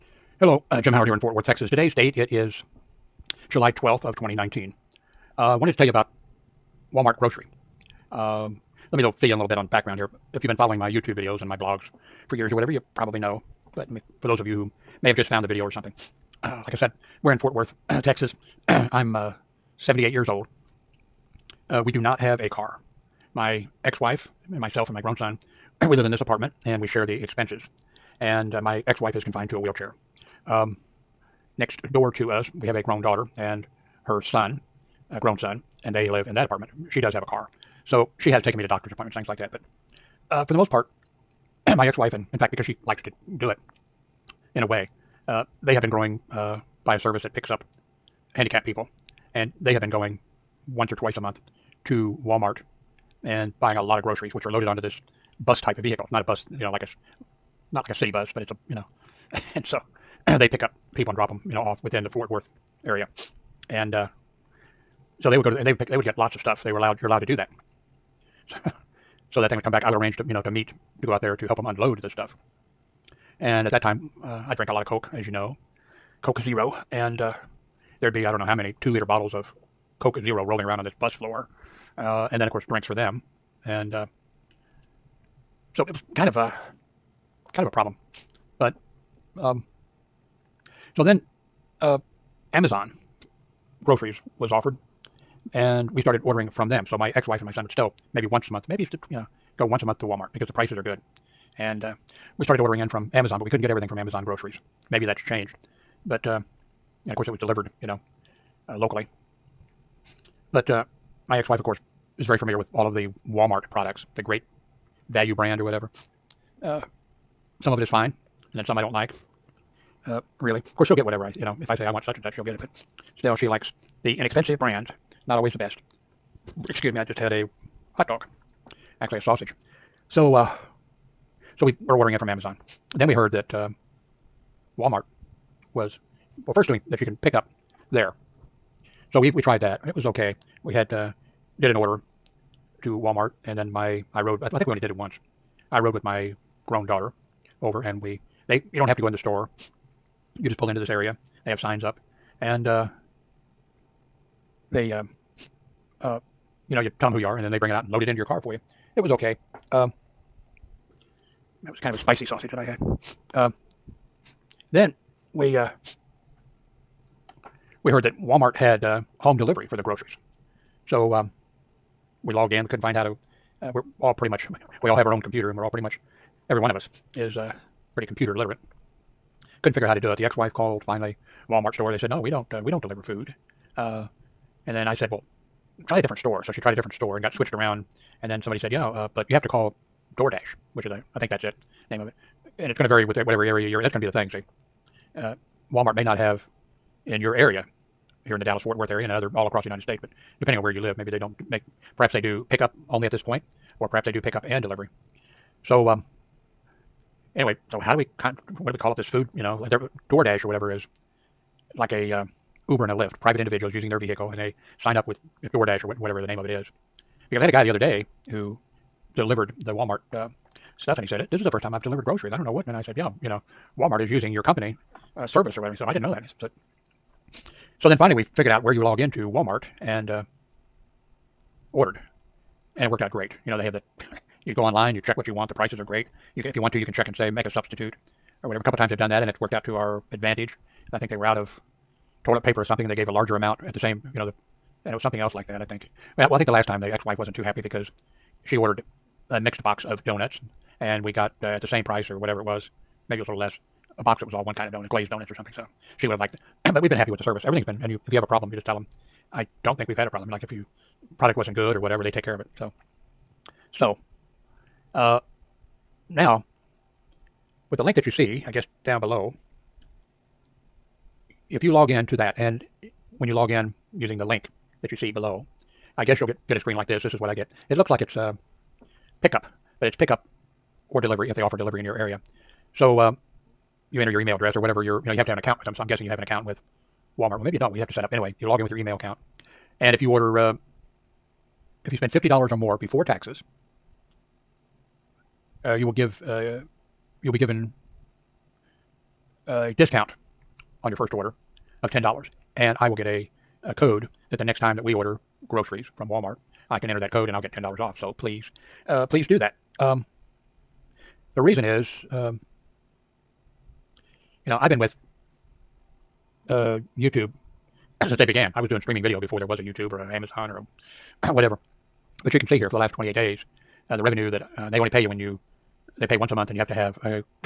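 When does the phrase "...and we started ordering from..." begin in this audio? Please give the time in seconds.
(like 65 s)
95 s.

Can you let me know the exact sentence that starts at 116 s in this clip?
Uh, some of it is fine, and then some I don't like.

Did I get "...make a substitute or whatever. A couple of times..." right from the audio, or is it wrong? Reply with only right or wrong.
right.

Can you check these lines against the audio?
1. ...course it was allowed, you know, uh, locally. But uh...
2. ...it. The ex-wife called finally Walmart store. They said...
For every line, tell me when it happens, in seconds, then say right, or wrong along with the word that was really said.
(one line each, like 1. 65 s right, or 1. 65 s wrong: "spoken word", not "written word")
1. 107 s wrong: "delivered", not "allowed"
2. 180 s right.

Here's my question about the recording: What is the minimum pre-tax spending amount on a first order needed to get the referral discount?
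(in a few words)
$50.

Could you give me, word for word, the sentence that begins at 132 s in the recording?
Then we heard that uh, Walmart was well, first doing that you can pick up there.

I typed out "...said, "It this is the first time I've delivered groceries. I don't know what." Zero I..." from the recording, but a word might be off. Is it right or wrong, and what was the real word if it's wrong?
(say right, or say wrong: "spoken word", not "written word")
wrong: "And", not "Zero".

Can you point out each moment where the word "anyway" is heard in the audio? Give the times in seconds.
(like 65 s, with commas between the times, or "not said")
207 s, 288 s.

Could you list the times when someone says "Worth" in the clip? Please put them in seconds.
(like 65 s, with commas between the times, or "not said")
1 s, 17 s, 62 s, 198 s.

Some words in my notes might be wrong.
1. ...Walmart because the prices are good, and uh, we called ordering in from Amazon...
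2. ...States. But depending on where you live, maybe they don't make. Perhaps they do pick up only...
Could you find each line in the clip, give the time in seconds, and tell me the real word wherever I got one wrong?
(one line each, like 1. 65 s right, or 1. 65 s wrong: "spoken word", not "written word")
1. 100 s wrong: "started", not "called"
2. 199 s right.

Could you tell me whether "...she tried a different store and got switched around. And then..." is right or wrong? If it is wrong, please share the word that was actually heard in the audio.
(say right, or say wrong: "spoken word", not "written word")
right.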